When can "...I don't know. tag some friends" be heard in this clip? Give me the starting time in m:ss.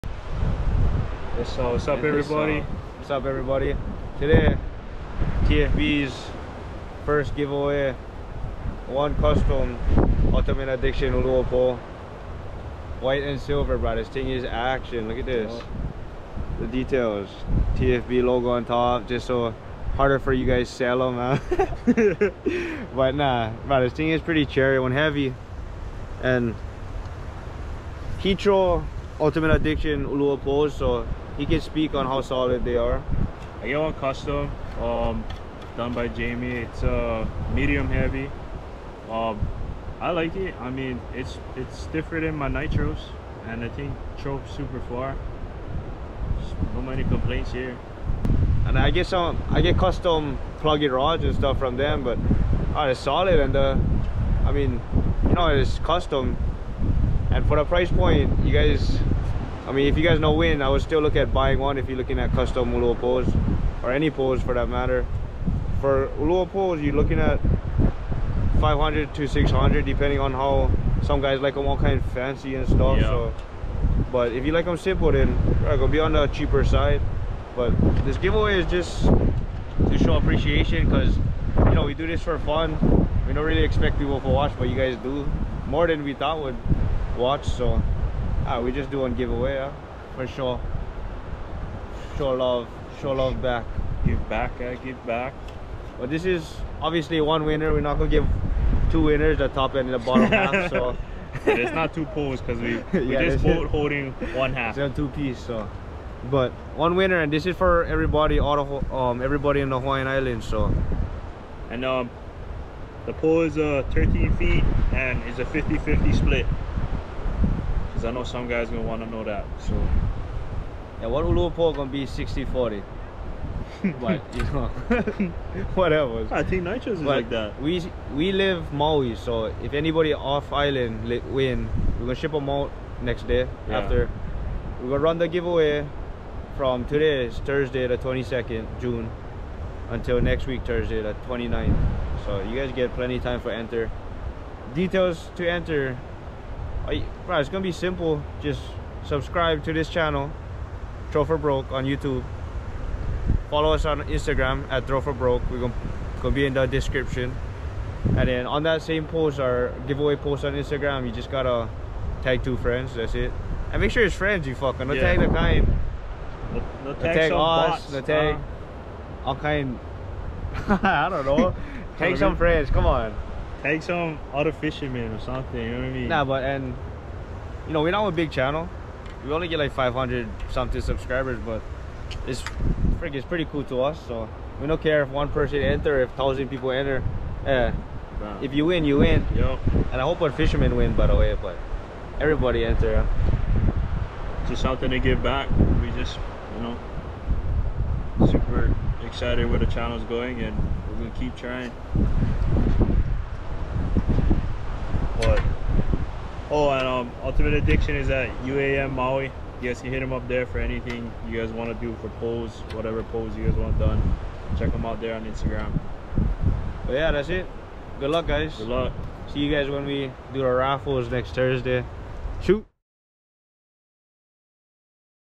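2:50.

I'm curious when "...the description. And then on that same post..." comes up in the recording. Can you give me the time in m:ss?
2:36.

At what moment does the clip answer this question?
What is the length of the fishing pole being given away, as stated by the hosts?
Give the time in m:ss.
1:53.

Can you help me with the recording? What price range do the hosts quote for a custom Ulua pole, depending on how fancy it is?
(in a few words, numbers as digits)
500 to 600.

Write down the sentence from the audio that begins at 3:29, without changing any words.
You guys can hit him up there for anything you guys want to do for pose, whatever pose you guys want done.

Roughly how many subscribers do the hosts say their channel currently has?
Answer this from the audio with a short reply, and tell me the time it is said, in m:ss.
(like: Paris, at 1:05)
500, at 2:59.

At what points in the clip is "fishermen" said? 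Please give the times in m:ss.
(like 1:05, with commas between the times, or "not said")
2:54, 3:10.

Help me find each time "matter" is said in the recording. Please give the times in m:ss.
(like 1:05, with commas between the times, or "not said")
1:04.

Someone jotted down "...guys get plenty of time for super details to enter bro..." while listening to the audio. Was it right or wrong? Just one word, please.
wrong.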